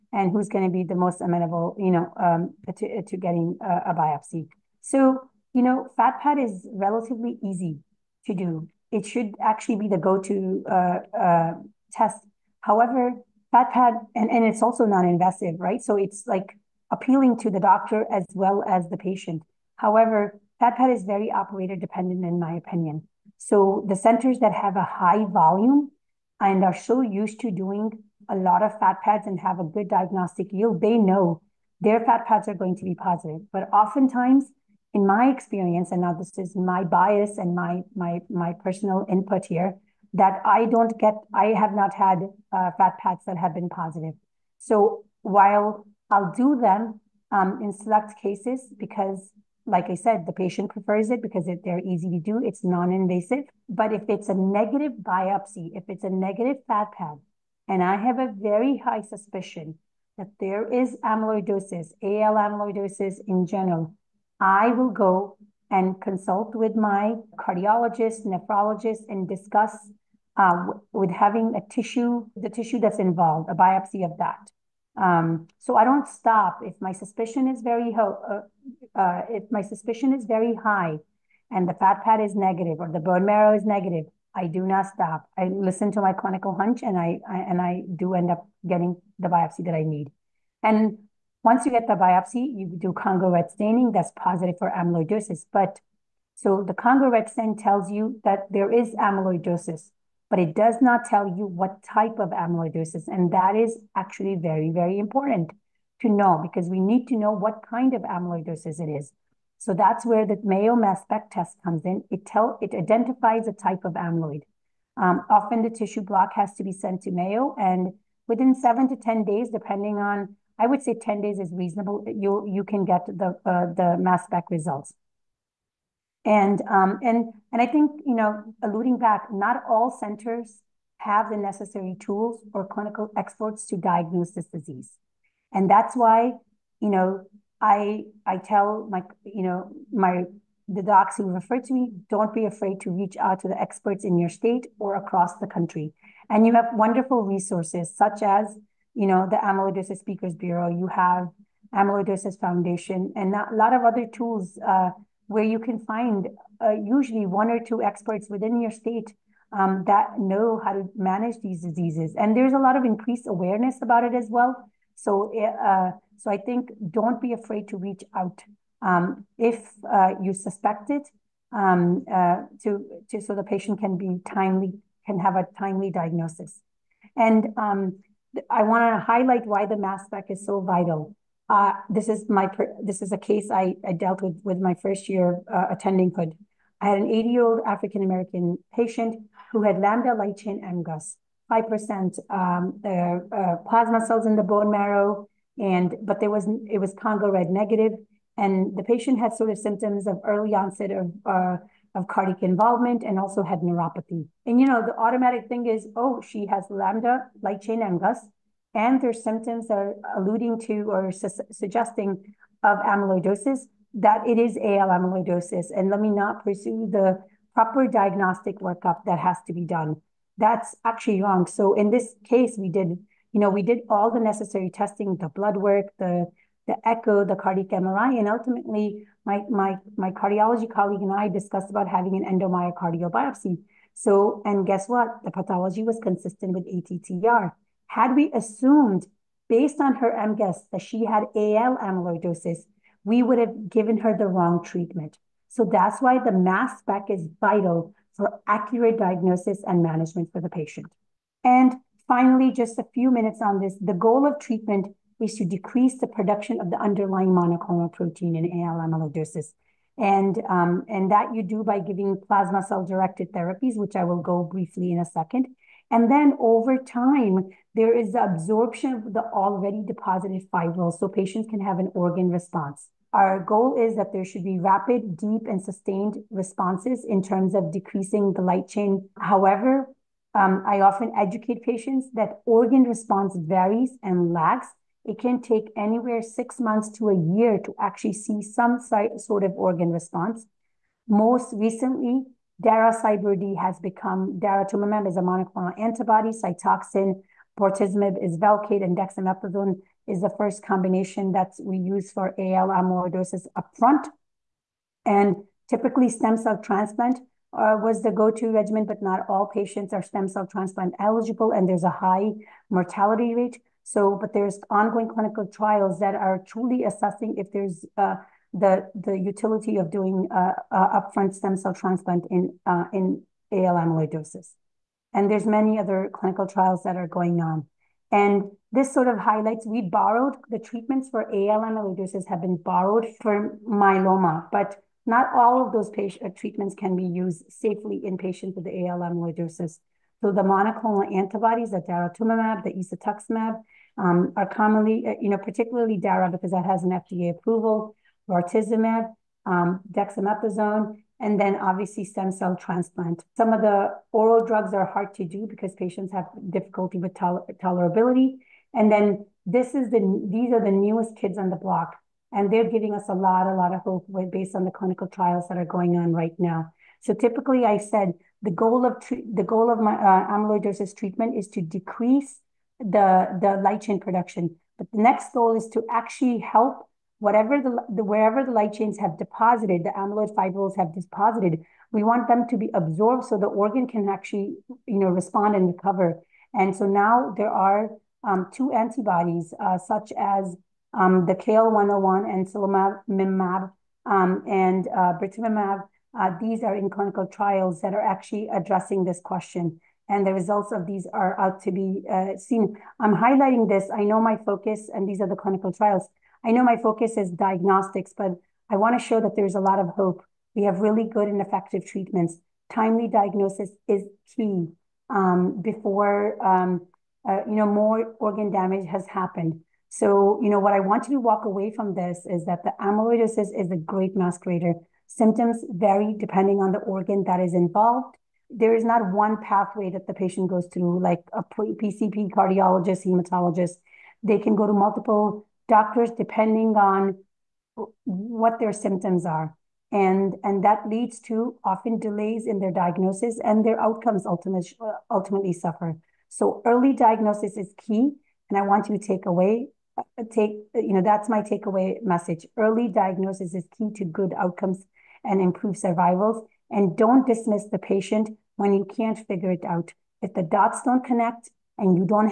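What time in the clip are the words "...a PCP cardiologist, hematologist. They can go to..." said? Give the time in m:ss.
7:11.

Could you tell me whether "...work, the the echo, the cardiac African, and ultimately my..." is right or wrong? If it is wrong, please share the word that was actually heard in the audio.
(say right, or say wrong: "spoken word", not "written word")
wrong: "MRI", not "African".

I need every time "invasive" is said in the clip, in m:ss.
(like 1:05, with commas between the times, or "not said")
0:14, 0:52.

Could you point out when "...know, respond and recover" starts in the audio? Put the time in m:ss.
6:24.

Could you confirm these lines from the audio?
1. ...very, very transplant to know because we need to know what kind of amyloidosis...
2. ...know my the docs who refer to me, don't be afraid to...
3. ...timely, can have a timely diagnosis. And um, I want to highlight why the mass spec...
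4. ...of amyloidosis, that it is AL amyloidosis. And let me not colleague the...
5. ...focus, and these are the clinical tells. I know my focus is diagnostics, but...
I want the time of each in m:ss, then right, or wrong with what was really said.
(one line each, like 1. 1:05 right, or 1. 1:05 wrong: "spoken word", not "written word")
1. 1:44 wrong: "important", not "transplant"
2. 2:19 right
3. 2:54 right
4. 3:32 wrong: "pursue", not "colleague"
5. 6:44 wrong: "trials", not "tells".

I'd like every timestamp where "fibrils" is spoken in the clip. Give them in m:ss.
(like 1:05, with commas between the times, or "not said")
4:30, 6:20.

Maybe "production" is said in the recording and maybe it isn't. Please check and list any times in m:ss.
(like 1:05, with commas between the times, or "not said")
4:16, 6:13.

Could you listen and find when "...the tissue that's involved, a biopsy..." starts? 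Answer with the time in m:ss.
1:12.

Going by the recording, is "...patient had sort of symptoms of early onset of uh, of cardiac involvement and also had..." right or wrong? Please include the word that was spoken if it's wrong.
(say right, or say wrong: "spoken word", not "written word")
right.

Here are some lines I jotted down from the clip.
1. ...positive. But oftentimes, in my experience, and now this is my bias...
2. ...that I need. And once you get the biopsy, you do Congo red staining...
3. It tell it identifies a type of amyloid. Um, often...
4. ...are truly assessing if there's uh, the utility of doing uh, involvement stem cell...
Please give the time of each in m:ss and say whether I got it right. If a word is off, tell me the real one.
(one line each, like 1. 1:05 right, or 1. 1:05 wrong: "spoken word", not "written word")
1. 0:32 right
2. 1:29 right
3. 1:52 right
4. 5:16 wrong: "upfront", not "involvement".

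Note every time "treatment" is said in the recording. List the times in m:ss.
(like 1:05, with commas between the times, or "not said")
4:04, 4:14, 5:30, 5:36, 6:10, 6:51.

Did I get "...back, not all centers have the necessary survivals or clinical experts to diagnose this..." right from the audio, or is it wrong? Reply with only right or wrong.
wrong.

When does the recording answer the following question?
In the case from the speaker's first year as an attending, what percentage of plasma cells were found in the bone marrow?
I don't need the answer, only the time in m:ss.
3:11.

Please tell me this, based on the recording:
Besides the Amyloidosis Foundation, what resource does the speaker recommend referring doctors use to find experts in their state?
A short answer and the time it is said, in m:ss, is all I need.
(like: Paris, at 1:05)
Amyloidosis Speakers Bureau, at 2:29.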